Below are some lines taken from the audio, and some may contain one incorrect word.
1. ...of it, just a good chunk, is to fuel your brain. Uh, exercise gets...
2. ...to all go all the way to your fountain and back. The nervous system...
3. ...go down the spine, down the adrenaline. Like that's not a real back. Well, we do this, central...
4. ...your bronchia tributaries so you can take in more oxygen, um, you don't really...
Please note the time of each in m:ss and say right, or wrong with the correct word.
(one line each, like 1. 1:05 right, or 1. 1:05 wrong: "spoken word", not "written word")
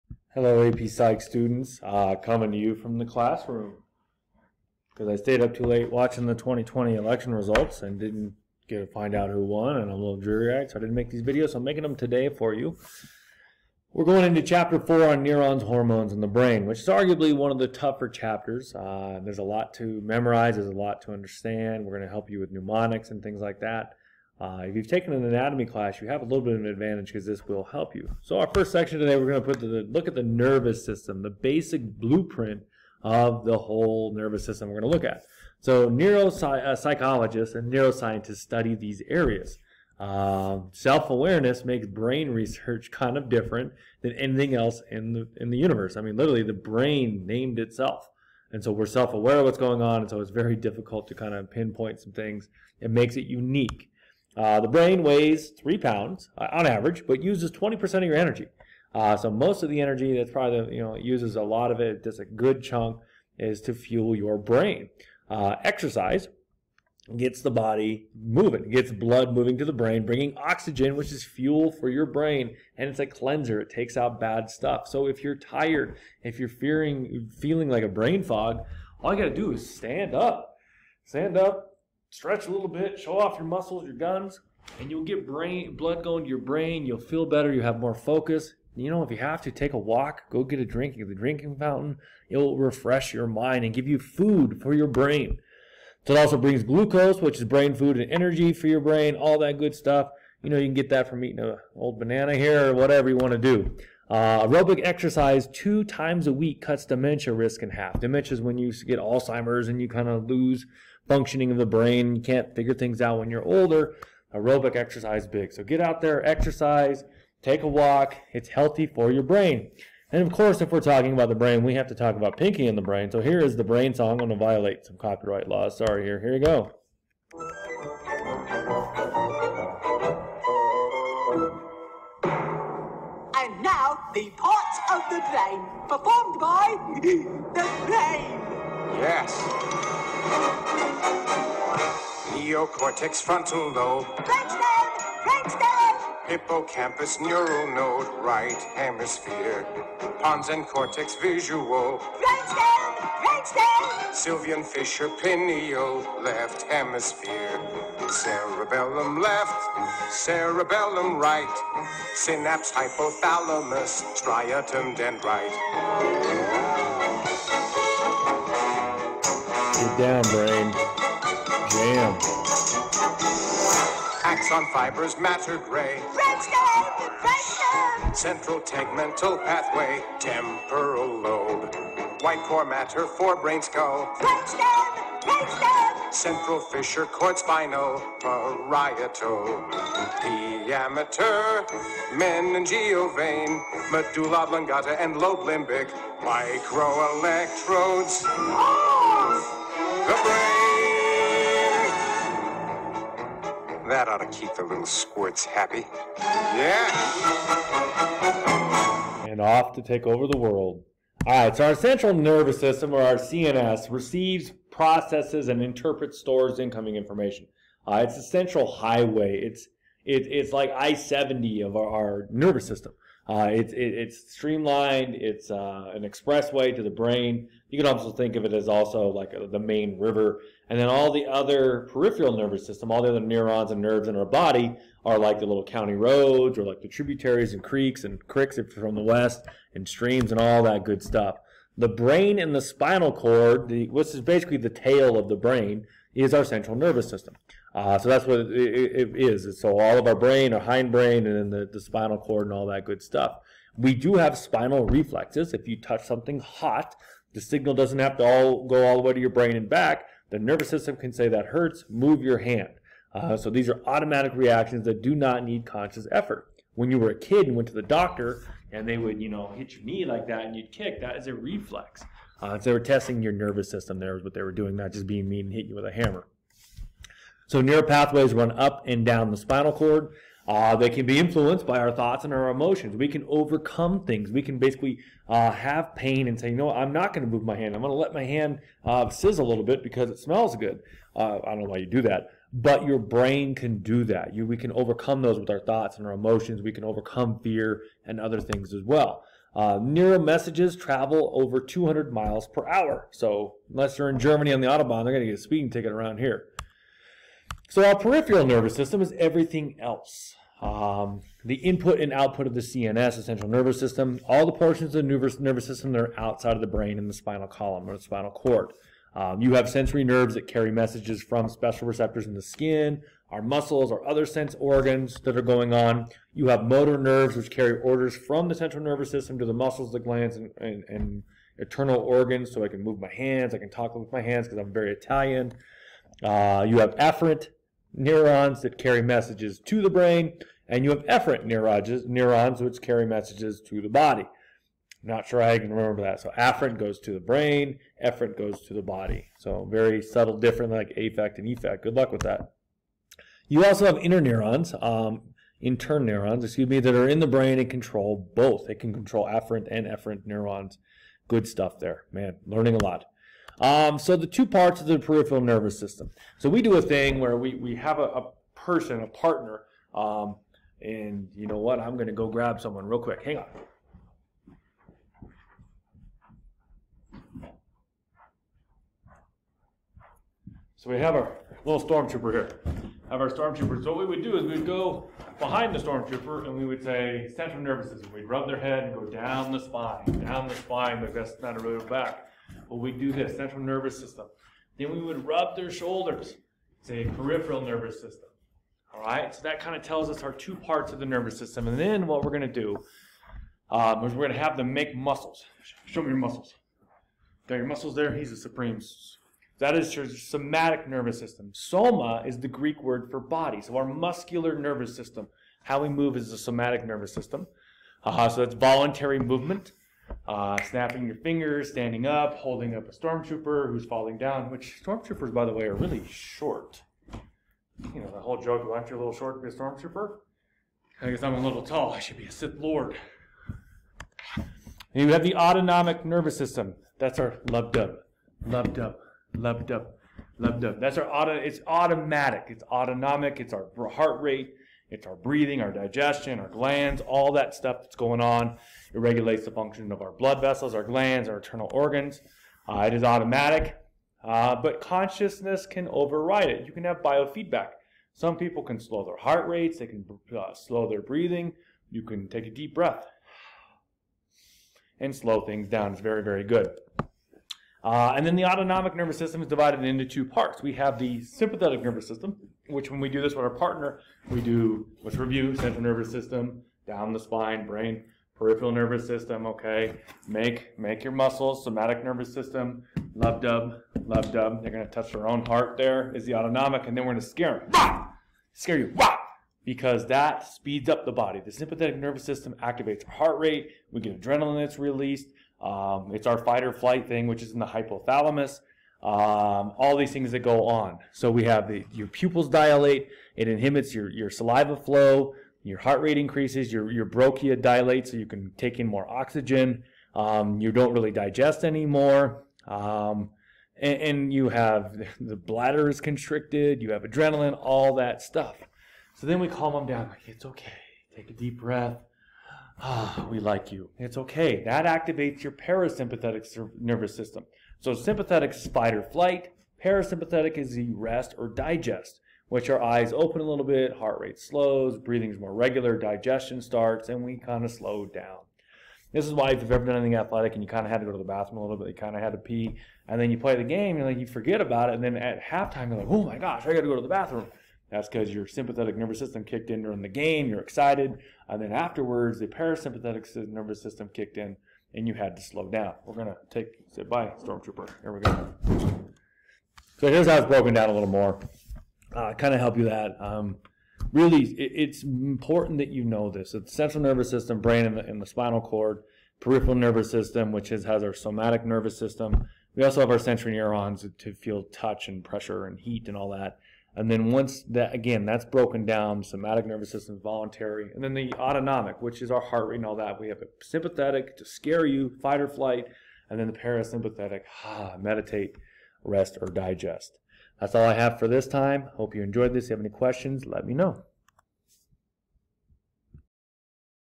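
1. 1:01 right
2. 4:18 wrong: "brain", not "fountain"
3. 6:28 wrong: "spine", not "adrenaline"
4. 8:26 wrong: "dilates", not "tributaries".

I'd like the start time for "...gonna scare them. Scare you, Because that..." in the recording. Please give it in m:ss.
8:07.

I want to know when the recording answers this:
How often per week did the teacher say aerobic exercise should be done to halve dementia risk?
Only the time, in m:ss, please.
1:45.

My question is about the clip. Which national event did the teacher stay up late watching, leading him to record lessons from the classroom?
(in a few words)
2020 election results.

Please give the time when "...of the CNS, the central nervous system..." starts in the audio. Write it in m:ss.
5:12.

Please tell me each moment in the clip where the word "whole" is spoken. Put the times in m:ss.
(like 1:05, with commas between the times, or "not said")
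0:33, 7:08.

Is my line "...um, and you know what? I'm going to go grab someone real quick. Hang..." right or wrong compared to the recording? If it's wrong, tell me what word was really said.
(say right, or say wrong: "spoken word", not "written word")
right.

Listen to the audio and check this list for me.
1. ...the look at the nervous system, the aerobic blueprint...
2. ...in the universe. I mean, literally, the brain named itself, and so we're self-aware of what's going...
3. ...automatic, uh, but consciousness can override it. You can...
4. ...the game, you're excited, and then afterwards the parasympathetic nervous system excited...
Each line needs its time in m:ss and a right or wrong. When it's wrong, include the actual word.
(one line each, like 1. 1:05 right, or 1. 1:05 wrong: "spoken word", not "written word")
1. 0:29 wrong: "basic", not "aerobic"
2. 0:45 right
3. 7:33 right
4. 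9:10 wrong: "kicked", not "excited".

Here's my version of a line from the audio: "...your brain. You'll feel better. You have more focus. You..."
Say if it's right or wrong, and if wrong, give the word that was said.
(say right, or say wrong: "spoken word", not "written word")
right.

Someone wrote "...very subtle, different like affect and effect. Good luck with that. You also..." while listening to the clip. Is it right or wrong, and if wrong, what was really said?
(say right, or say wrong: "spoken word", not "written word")
right.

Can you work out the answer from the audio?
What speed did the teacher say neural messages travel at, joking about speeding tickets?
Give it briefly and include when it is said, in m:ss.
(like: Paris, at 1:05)
over 200 miles per hour, at 5:01.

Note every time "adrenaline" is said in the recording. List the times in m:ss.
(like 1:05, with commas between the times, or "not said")
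8:14, 8:37.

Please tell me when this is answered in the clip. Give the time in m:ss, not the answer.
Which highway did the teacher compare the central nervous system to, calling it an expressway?
3:40.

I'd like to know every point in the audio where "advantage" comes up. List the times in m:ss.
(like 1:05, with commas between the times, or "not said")
0:26.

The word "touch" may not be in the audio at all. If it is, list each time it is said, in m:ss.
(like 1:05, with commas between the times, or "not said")
4:15, 8:04, 9:34.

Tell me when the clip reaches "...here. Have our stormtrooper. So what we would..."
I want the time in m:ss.
6:22.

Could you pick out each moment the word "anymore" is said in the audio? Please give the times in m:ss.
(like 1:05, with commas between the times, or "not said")
8:31.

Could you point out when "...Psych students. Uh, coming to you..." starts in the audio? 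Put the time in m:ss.
0:00.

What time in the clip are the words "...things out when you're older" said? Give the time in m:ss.
1:52.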